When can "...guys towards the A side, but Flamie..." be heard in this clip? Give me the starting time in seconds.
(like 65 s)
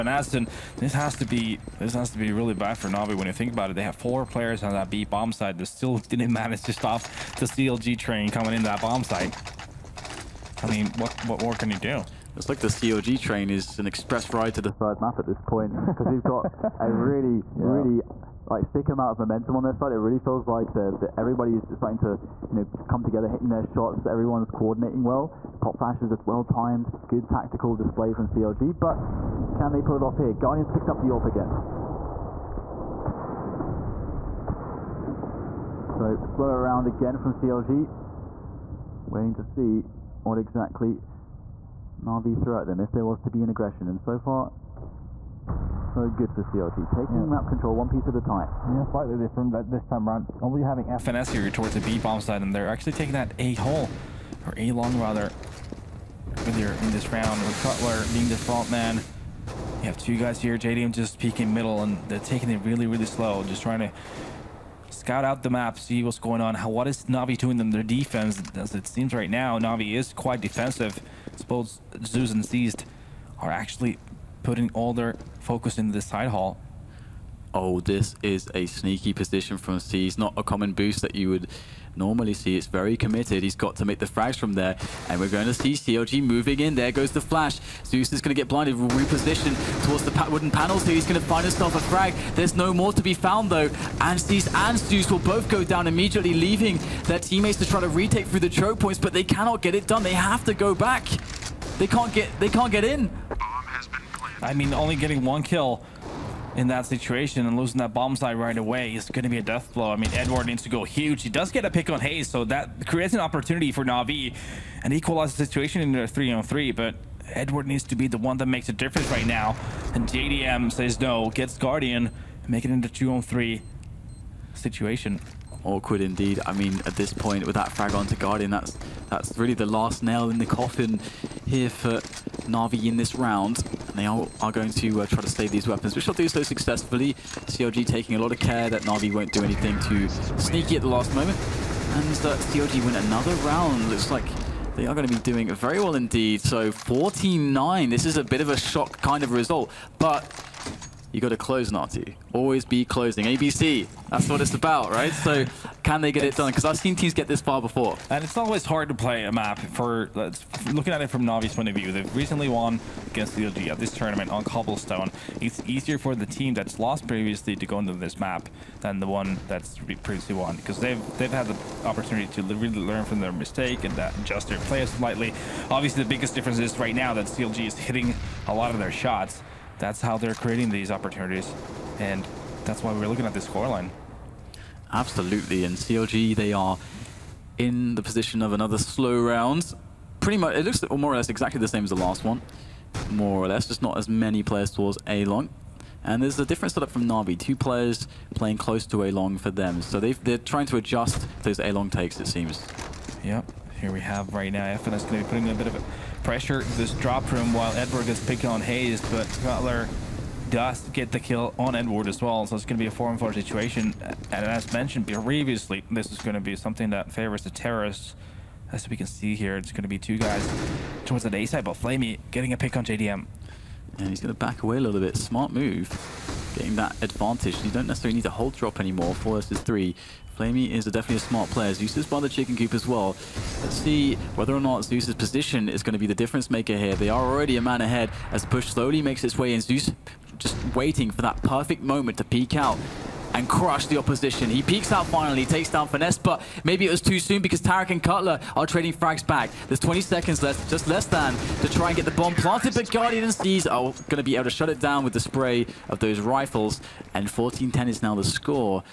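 220 s.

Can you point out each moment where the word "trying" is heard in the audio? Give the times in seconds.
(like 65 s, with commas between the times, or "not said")
63 s, 200 s.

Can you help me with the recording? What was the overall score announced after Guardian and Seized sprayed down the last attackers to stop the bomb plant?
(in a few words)
14-10.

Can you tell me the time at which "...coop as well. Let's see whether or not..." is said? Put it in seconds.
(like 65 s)
232 s.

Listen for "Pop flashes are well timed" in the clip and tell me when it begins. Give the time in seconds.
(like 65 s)
25 s.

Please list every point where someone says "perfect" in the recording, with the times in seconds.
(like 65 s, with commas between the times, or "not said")
241 s.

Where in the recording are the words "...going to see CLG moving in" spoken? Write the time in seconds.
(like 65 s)
85 s.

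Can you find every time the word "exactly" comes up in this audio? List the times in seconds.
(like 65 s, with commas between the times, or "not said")
40 s, 191 s.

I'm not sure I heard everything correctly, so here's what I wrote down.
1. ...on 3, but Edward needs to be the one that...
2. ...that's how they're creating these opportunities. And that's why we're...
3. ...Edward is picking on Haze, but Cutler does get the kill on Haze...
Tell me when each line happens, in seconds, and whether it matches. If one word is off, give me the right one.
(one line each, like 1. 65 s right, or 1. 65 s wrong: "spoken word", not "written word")
1. 116 s right
2. 179 s right
3. 207 s wrong: "Edward", not "Haze".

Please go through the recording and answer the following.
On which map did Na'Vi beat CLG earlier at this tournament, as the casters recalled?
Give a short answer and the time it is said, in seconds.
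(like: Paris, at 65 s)
Cobblestone, at 164 s.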